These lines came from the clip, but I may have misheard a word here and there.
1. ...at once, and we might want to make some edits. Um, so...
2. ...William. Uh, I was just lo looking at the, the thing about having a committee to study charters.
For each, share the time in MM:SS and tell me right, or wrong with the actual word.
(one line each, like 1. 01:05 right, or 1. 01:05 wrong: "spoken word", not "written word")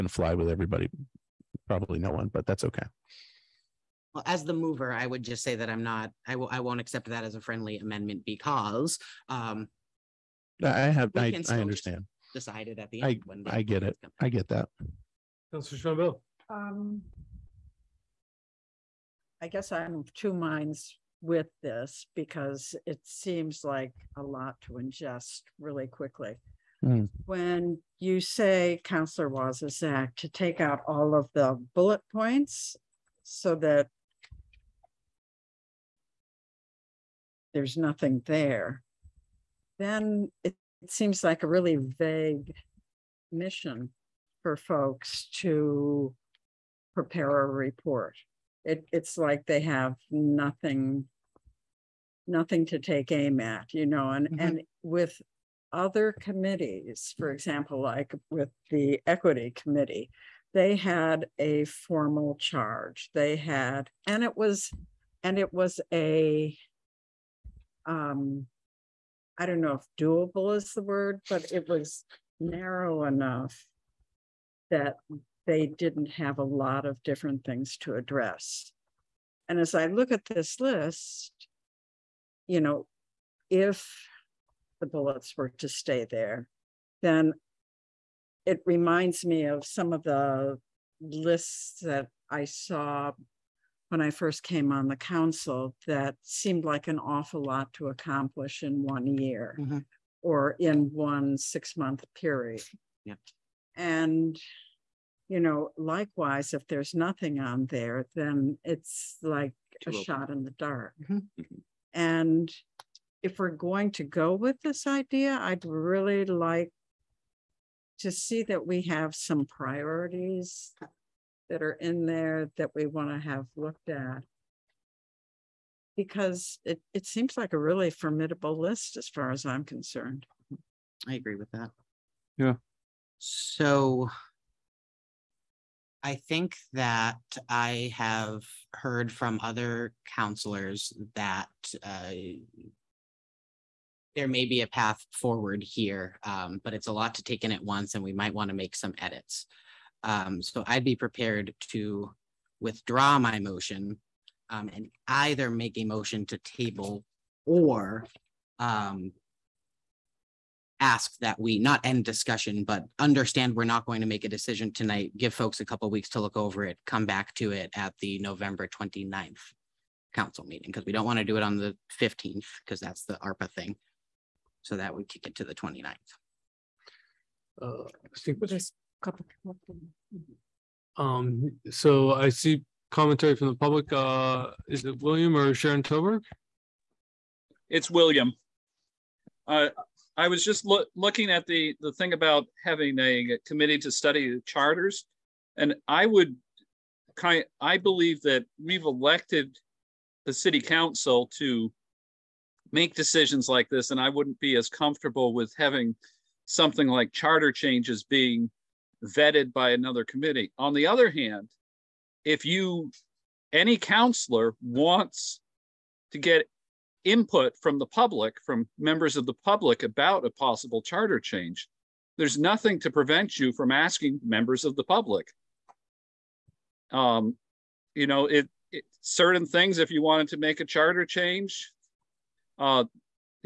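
1. 02:27 right
2. 03:07 right.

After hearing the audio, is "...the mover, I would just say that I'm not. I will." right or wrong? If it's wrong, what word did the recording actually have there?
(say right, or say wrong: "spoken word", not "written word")
right.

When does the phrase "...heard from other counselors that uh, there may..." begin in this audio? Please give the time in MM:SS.
02:18.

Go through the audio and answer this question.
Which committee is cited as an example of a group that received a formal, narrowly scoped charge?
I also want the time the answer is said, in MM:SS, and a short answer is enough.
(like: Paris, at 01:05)
equity committee, at 00:59.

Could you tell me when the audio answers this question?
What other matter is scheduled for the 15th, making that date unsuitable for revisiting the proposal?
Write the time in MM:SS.
02:53.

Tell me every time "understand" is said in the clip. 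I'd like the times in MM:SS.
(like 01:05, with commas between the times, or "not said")
00:11, 02:42.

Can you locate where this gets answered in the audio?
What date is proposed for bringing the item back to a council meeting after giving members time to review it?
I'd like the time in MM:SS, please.
02:48.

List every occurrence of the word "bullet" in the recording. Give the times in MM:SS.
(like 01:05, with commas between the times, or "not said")
00:31, 01:24.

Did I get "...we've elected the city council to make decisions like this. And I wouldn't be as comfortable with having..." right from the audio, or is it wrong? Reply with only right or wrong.
right.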